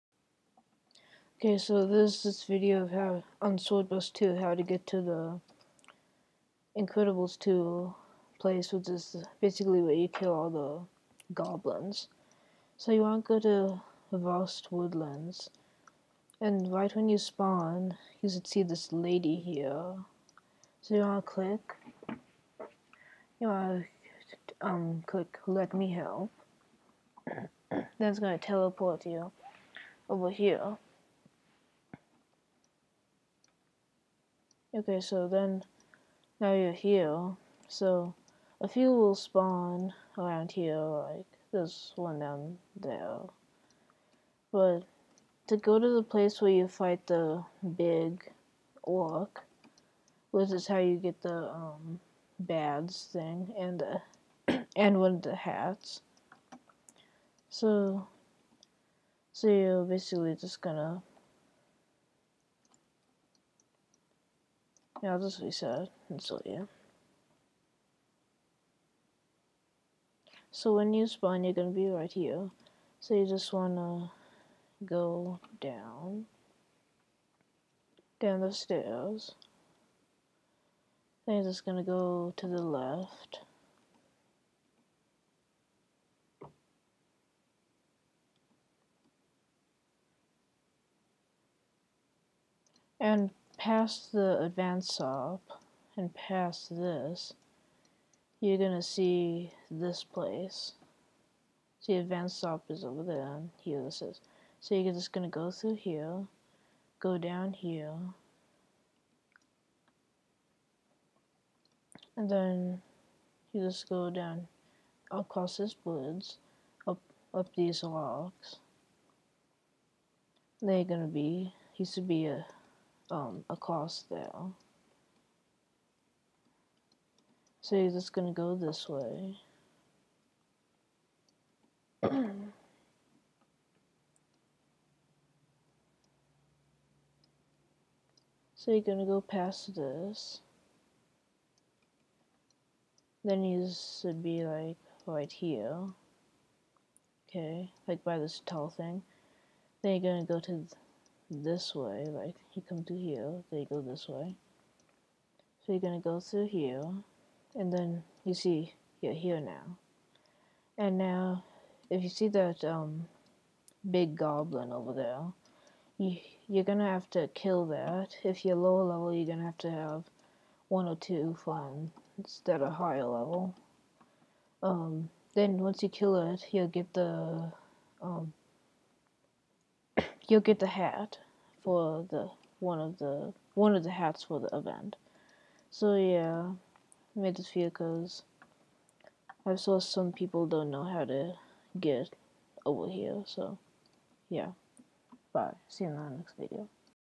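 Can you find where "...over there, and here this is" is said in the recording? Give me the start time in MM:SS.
01:42.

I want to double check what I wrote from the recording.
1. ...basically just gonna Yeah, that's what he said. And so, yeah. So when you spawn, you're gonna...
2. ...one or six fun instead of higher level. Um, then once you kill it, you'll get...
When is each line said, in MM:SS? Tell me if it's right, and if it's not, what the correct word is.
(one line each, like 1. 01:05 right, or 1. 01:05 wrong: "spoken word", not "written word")
1. 00:59 right
2. 02:50 wrong: "two", not "six".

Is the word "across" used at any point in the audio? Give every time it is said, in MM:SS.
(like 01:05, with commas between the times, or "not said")
01:55, 02:03.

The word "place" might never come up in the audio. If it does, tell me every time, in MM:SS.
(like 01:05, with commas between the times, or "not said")
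00:08, 00:46, 01:40.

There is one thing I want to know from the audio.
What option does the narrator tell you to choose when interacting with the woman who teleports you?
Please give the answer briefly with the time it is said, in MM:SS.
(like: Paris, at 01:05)
Let Me Help, at 00:25.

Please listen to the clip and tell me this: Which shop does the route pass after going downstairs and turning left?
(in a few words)
advance stop.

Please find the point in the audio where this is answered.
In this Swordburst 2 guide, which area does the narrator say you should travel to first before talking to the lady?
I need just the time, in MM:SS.
00:14.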